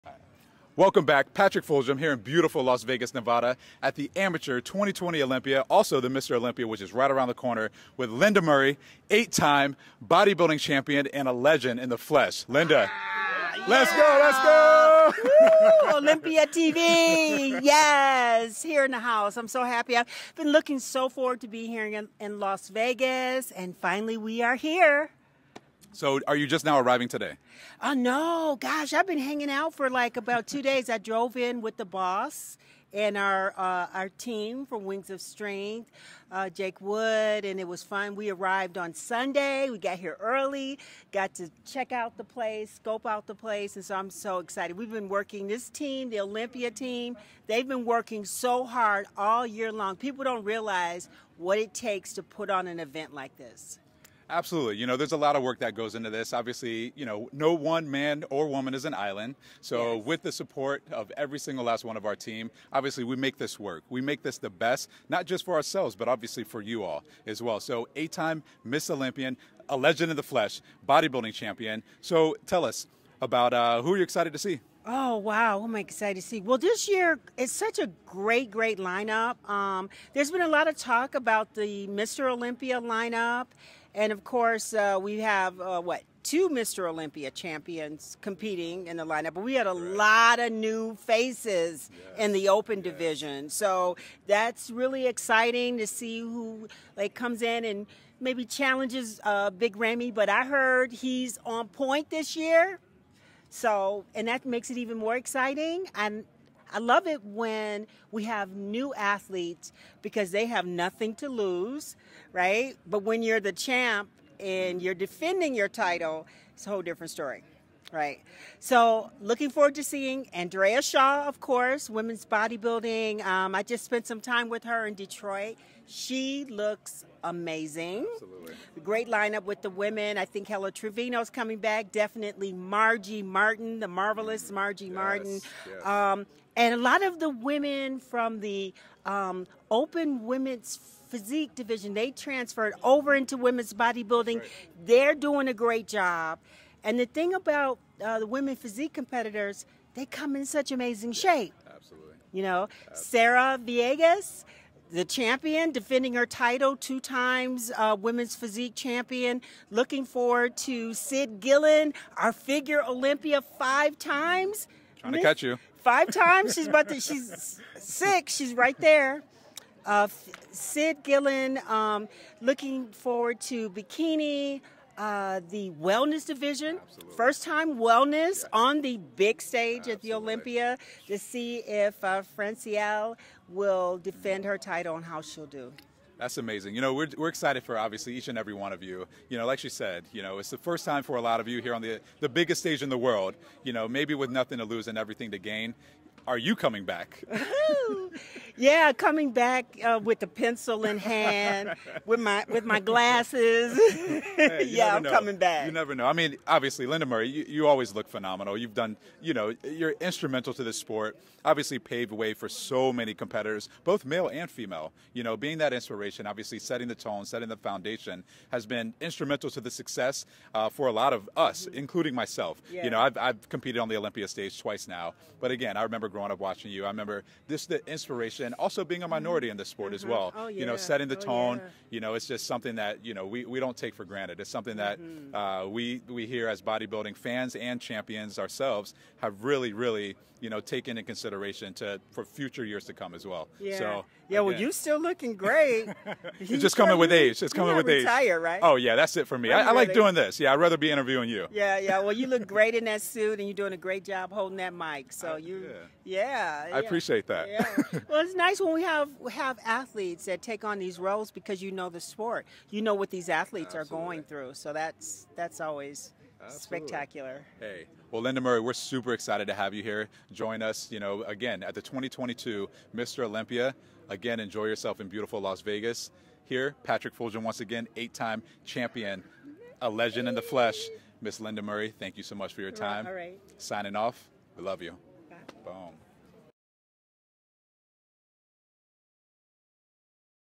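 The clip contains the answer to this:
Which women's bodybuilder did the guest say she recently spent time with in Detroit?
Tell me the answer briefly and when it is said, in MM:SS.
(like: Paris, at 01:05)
Andrea Shaw, at 02:00.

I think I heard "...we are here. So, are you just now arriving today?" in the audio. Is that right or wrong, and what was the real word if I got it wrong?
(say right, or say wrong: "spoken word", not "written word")
right.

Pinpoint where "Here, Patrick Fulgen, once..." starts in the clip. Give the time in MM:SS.
04:36.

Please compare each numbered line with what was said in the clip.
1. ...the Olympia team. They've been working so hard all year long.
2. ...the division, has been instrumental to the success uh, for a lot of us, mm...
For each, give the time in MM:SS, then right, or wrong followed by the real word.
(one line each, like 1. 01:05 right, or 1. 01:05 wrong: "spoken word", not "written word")
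1. 00:46 right
2. 03:37 wrong: "foundation", not "division".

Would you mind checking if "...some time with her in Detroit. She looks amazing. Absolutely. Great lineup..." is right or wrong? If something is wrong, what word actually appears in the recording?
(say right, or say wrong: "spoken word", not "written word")
right.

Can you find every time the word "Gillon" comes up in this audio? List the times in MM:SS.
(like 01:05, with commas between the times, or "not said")
02:41, 02:51.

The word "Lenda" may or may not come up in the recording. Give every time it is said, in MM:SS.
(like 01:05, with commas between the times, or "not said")
00:08, 00:12, 03:26, 04:28, 04:41.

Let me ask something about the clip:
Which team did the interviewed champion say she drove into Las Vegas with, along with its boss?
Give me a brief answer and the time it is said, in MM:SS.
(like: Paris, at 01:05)
Wings of Strength, at 00:34.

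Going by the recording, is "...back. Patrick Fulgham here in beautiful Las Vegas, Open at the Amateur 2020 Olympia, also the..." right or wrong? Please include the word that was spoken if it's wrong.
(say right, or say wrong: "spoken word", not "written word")
wrong: "Nevada", not "Open".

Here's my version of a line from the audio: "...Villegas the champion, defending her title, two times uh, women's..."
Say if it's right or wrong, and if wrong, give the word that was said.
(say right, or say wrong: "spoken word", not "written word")
right.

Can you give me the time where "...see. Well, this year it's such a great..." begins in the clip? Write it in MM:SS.
01:16.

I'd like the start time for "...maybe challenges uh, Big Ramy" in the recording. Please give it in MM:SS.
01:38.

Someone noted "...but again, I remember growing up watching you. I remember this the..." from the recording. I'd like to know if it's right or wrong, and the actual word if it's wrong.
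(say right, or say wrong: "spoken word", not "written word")
right.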